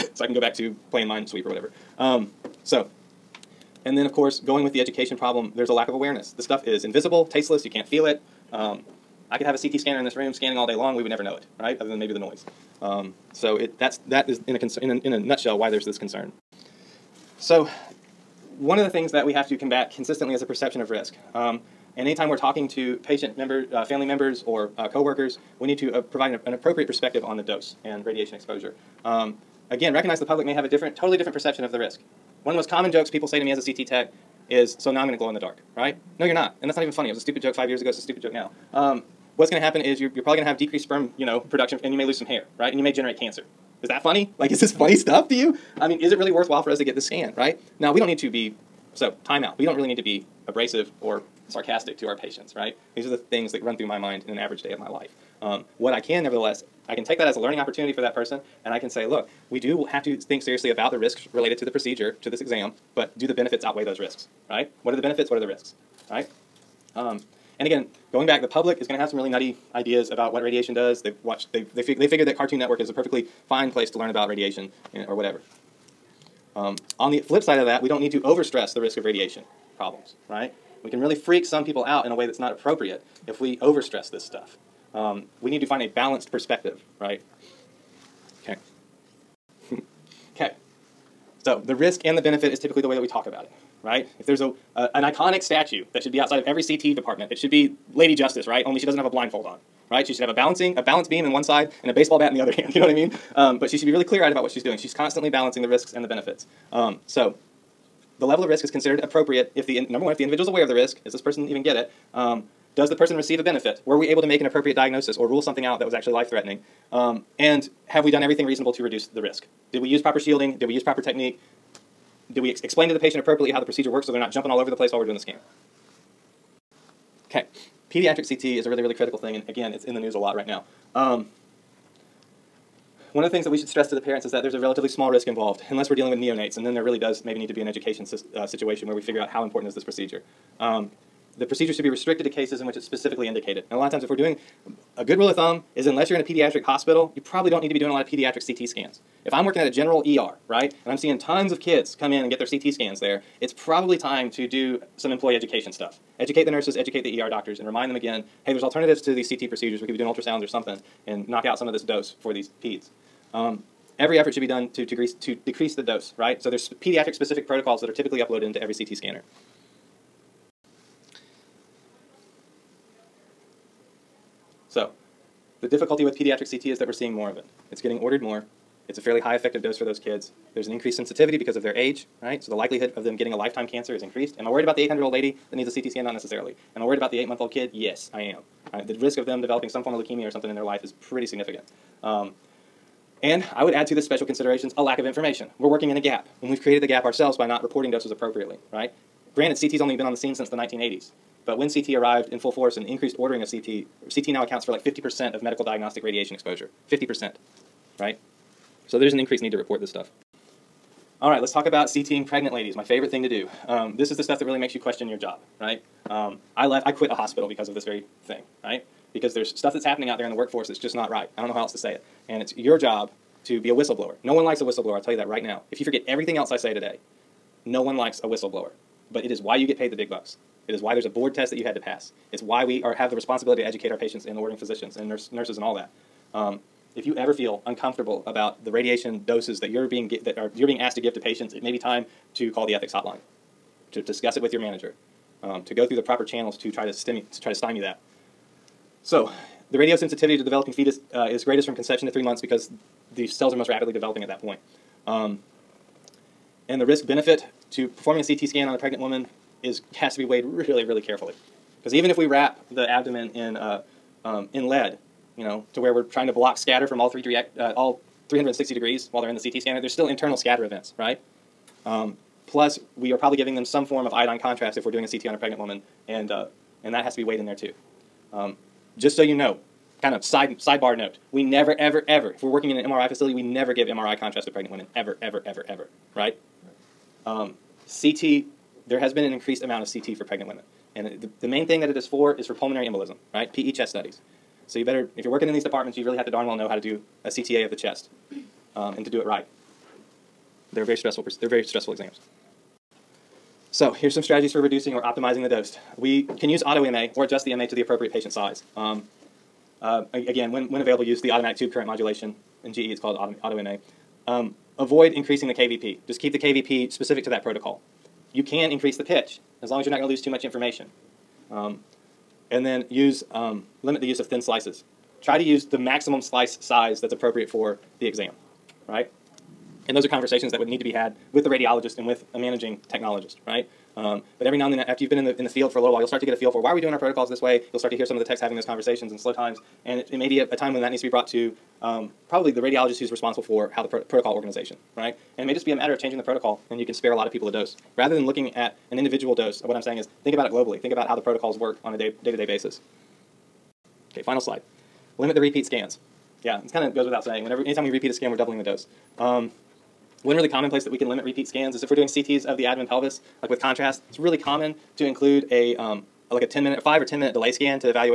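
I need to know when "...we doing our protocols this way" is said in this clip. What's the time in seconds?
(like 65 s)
336 s.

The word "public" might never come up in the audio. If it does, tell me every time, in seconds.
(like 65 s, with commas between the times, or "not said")
30 s, 68 s.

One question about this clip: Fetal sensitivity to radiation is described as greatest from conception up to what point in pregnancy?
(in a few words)
3 months.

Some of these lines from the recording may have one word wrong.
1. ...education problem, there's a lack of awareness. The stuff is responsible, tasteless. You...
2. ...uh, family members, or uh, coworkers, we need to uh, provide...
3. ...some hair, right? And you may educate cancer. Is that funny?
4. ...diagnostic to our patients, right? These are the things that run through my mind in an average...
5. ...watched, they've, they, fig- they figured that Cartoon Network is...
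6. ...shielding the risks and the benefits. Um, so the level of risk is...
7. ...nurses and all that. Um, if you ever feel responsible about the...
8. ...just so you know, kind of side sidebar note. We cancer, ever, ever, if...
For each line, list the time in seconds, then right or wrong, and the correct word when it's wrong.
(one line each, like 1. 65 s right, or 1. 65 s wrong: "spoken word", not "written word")
1. 4 s wrong: "invisible", not "responsible"
2. 23 s right
3. 42 s wrong: "generate", not "educate"
4. 51 s wrong: "sarcastic", not "diagnostic"
5. 71 s right
6. 105 s wrong: "balancing", not "shielding"
7. 235 s wrong: "uncomfortable", not "responsible"
8. 278 s wrong: "never", not "cancer".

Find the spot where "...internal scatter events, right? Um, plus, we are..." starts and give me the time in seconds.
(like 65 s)
270 s.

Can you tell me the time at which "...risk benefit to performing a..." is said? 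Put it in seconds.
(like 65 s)
256 s.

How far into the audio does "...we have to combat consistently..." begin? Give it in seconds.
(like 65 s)
19 s.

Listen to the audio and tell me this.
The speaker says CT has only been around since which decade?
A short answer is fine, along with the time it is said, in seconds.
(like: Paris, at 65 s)
1980s, at 200 s.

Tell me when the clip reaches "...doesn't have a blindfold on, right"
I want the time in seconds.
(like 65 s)
98 s.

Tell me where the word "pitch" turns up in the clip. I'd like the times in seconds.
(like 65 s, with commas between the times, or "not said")
319 s.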